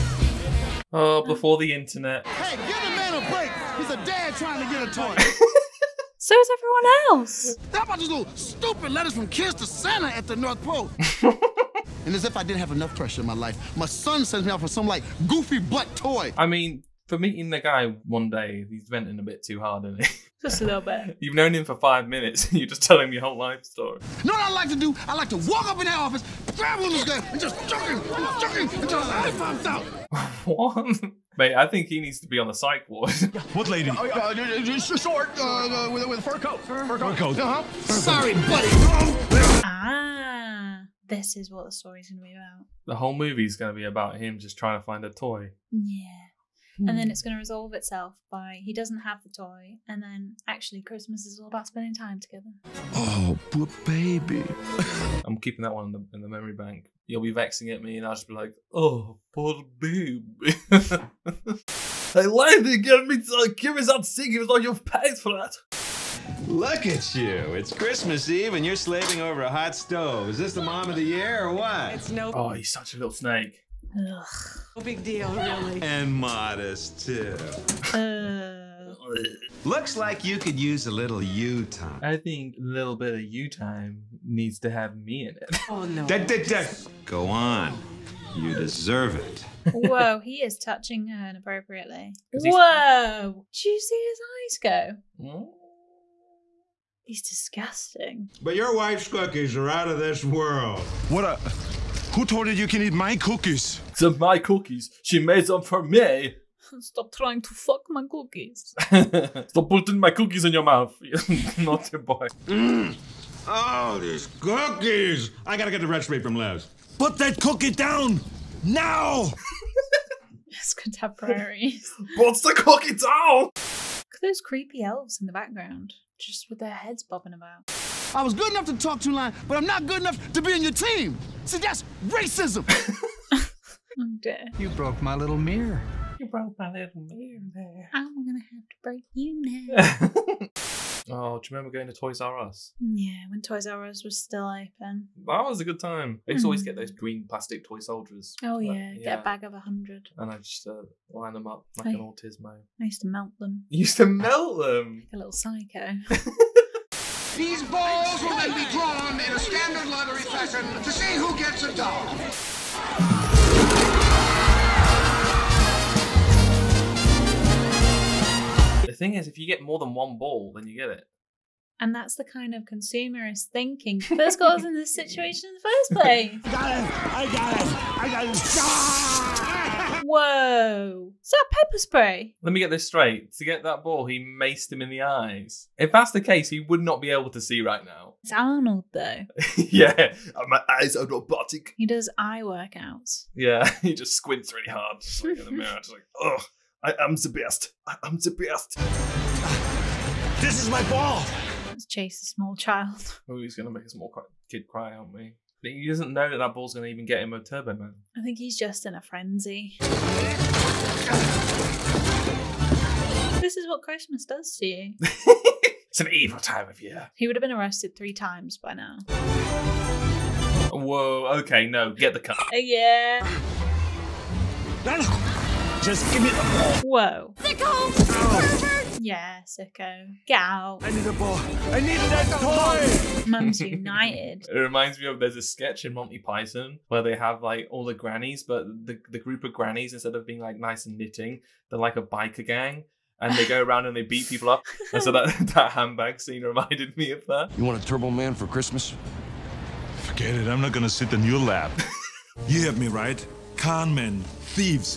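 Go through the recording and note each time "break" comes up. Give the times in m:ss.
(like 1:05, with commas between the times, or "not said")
0:03, 2:18.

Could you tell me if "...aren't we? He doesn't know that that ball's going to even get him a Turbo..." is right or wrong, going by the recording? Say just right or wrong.
right.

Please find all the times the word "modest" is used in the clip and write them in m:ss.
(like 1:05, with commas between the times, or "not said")
1:16.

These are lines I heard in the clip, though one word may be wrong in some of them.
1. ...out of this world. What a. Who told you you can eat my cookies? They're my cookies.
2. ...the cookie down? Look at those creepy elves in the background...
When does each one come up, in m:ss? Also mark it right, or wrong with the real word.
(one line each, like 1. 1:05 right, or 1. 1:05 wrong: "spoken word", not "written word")
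1. 1:39 right
2. 2:02 right.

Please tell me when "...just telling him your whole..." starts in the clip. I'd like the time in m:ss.
0:22.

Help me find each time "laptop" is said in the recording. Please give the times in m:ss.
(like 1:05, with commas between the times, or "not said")
not said.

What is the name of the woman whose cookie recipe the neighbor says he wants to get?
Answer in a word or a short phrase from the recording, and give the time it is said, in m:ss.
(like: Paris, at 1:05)
Liz, at 1:56.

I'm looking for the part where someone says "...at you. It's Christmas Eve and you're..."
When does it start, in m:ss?
1:06.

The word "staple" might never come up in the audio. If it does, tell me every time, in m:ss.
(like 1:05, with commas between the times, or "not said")
not said.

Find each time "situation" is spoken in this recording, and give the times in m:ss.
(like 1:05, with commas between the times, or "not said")
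2:54.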